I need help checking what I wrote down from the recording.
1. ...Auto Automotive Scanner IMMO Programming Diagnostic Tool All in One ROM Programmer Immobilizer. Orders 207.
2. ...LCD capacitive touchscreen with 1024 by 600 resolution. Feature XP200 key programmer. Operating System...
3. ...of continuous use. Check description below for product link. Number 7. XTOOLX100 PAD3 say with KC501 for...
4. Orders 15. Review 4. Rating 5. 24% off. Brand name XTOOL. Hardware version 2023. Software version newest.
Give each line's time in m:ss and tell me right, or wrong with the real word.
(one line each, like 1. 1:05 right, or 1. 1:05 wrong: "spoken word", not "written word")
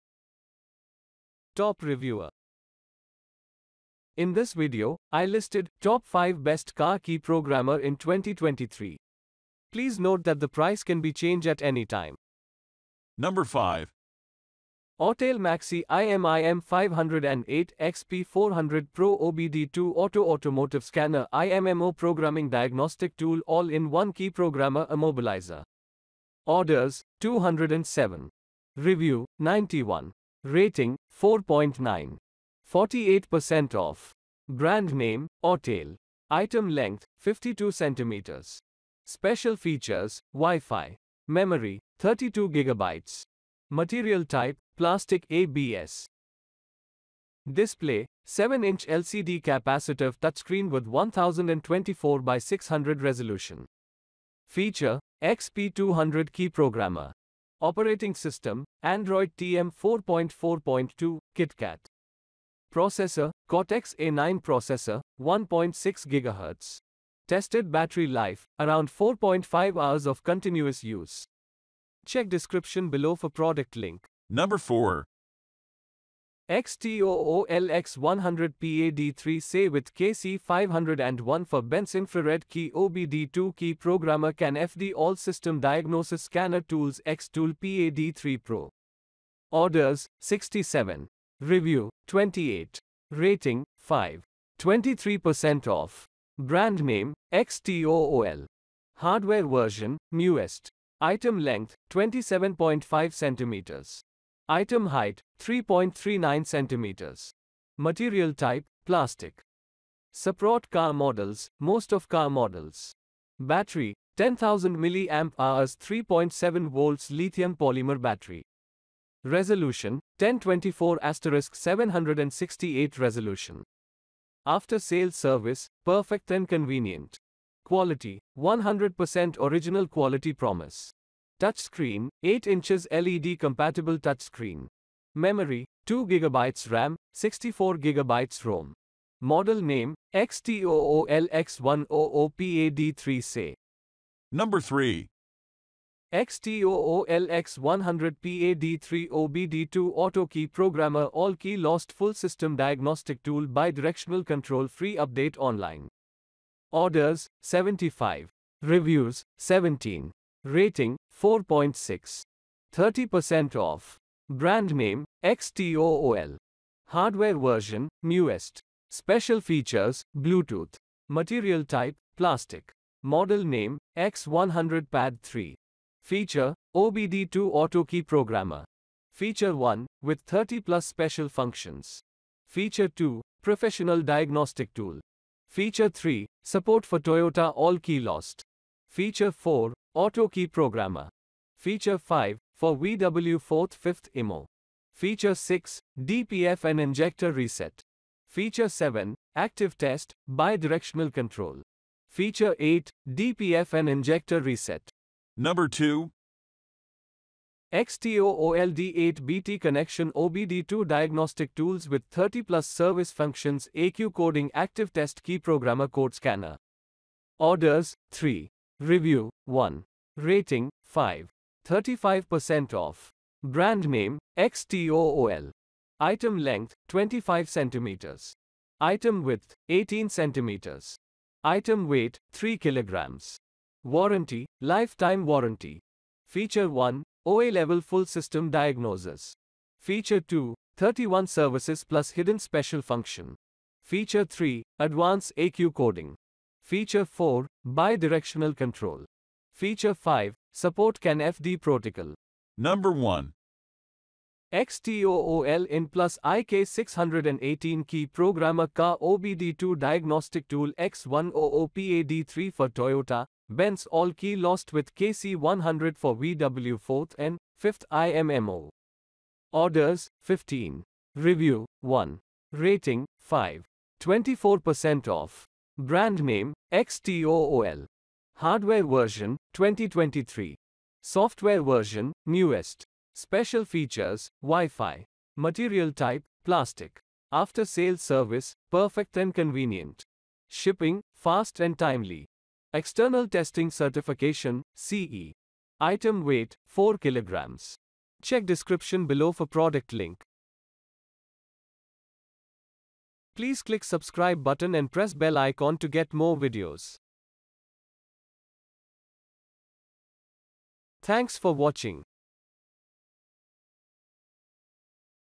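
1. 0:19 wrong: "Key", not "ROM"
2. 0:48 right
3. 1:10 wrong: "4", not "7"
4. 4:29 wrong: "1", not "4".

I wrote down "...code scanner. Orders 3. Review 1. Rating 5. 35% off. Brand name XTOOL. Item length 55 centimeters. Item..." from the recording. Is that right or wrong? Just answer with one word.
wrong.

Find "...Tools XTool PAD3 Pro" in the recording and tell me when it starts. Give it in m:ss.
1:26.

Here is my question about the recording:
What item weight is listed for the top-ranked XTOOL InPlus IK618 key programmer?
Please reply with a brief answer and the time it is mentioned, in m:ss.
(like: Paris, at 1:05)
4 kilograms, at 4:56.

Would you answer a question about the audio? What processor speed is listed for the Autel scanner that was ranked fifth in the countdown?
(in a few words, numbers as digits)
1.6 GHz.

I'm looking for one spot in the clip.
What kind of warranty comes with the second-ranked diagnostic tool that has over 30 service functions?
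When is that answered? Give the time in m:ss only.
3:54.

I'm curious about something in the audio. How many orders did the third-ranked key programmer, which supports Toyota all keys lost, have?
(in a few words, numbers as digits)
75.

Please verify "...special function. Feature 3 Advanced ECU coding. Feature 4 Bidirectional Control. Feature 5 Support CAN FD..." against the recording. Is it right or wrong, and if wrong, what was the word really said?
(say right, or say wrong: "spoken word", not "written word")
right.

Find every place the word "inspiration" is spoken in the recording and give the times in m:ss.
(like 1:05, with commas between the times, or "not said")
not said.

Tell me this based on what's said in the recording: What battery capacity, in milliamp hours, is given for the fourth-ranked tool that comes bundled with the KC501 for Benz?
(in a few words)
10,000 milliamp hours.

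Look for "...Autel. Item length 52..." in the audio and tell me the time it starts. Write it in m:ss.
0:35.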